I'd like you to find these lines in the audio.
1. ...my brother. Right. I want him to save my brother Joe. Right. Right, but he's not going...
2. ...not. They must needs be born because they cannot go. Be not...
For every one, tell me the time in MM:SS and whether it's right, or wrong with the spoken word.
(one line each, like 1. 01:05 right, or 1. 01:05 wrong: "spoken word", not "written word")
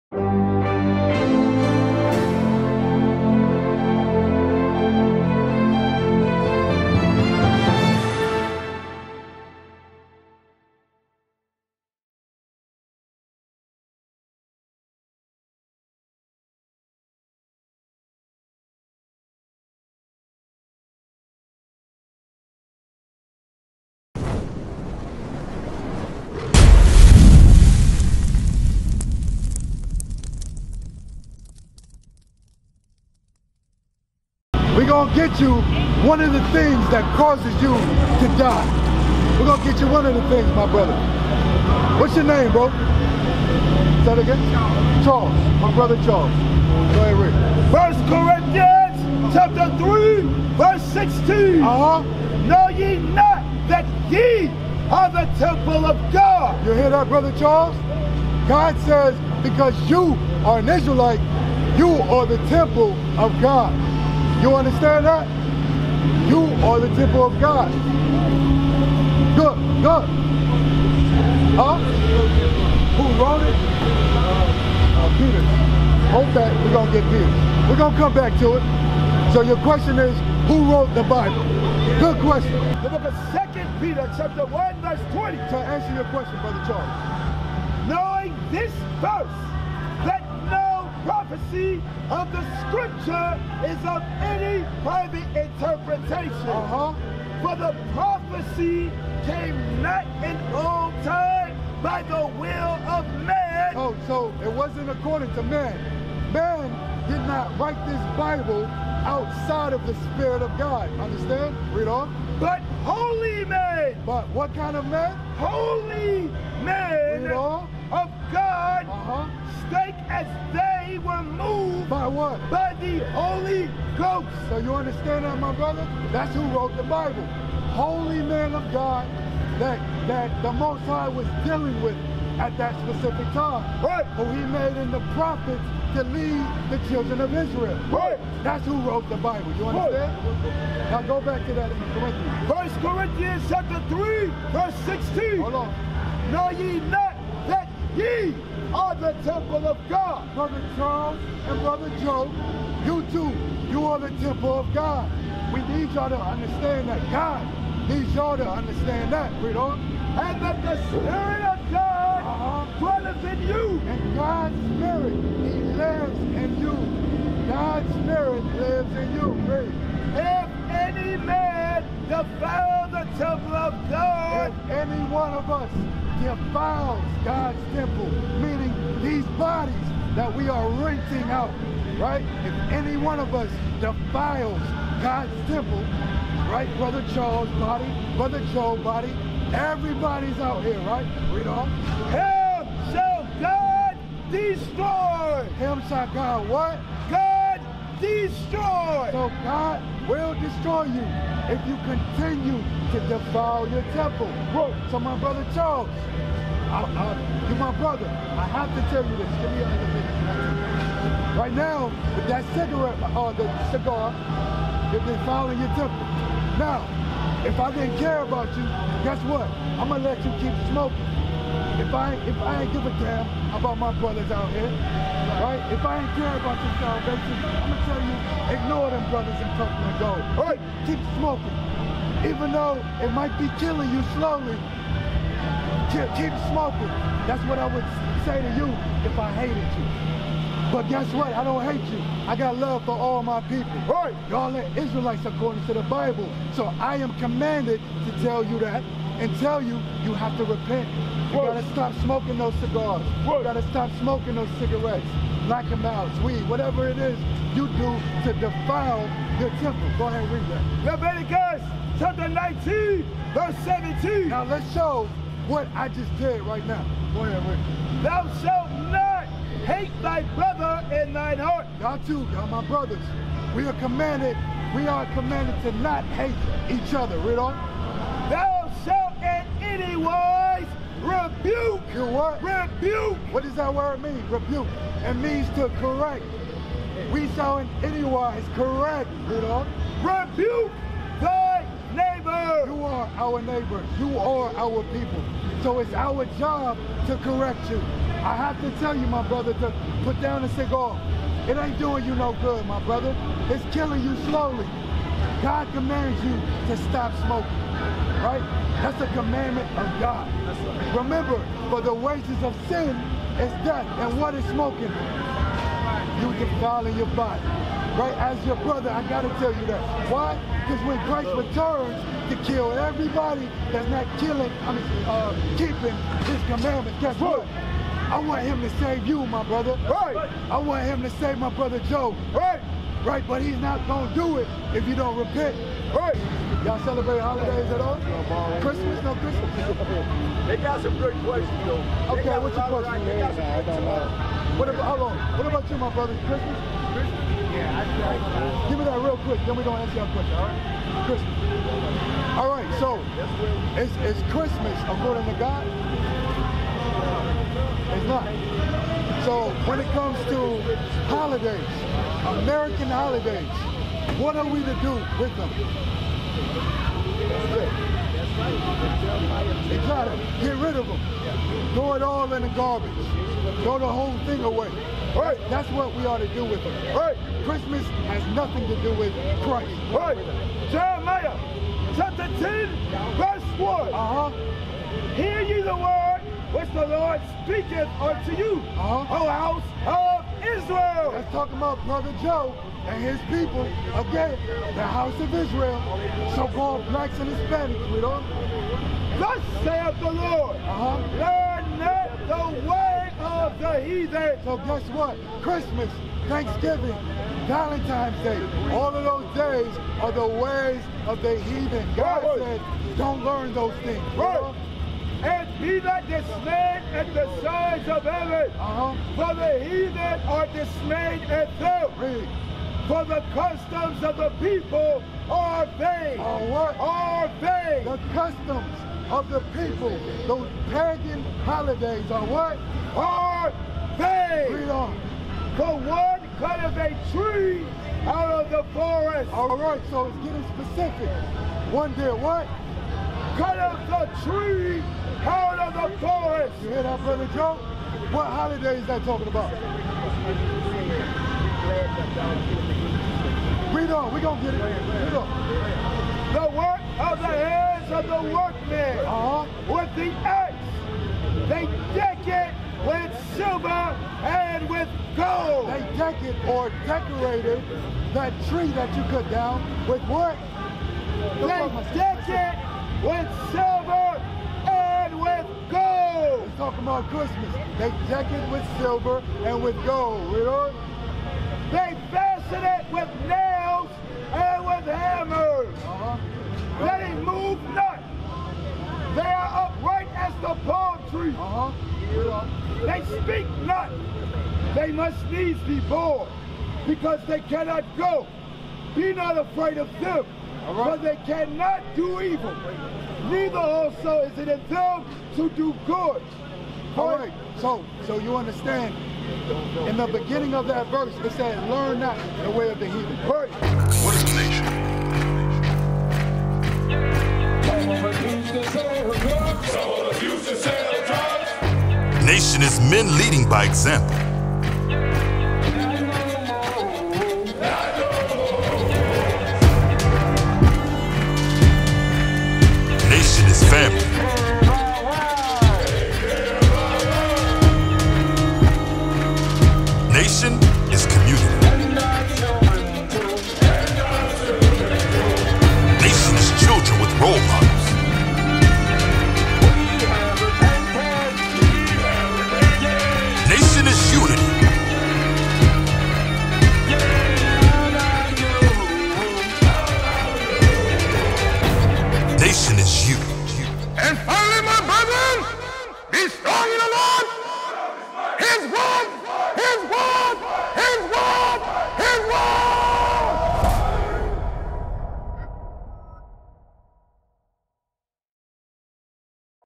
1. 05:29 right
2. 08:13 right.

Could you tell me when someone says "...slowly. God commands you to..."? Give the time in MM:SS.
05:04.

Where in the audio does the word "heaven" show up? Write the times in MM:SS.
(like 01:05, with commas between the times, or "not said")
06:58.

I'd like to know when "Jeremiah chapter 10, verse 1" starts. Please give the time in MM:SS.
06:20.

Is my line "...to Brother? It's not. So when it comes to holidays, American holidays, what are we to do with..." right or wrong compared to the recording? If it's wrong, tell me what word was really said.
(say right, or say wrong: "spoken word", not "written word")
wrong: "God", not "Brother".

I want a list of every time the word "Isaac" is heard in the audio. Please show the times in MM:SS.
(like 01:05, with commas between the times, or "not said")
not said.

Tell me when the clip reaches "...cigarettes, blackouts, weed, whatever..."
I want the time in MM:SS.
04:14.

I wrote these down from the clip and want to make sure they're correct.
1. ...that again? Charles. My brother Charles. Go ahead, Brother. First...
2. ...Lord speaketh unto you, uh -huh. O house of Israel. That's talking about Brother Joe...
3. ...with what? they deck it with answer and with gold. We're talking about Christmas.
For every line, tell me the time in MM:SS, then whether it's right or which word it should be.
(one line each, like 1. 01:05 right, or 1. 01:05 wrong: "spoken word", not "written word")
1. 00:44 wrong: "Rick", not "Brother"
2. 06:26 right
3. 07:49 wrong: "silver", not "answer".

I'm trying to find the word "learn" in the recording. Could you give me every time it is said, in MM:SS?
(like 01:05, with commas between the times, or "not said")
06:41, 06:53, 08:31.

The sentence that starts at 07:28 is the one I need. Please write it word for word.
What holiday is that talking about?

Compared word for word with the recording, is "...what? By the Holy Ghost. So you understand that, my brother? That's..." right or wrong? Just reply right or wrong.
right.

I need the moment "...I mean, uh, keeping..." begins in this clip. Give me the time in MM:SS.
05:24.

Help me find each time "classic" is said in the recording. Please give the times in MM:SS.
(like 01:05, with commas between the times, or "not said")
not said.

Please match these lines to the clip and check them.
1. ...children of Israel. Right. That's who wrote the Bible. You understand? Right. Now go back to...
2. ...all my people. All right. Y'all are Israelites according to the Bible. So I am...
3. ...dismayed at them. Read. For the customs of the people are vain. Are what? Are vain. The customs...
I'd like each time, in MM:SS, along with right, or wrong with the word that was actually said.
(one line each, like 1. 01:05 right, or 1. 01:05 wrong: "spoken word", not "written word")
1. 02:16 right
2. 04:02 right
3. 07:00 right.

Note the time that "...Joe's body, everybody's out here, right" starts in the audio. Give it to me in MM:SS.
03:08.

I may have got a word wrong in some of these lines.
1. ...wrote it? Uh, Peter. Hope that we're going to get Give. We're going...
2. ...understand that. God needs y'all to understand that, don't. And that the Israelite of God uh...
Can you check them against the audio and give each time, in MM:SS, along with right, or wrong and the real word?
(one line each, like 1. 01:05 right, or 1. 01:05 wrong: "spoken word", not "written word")
1. 01:13 wrong: "Peter", not "Give"
2. 02:36 wrong: "Spirit", not "Israelite".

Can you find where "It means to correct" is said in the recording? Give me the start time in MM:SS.
04:45.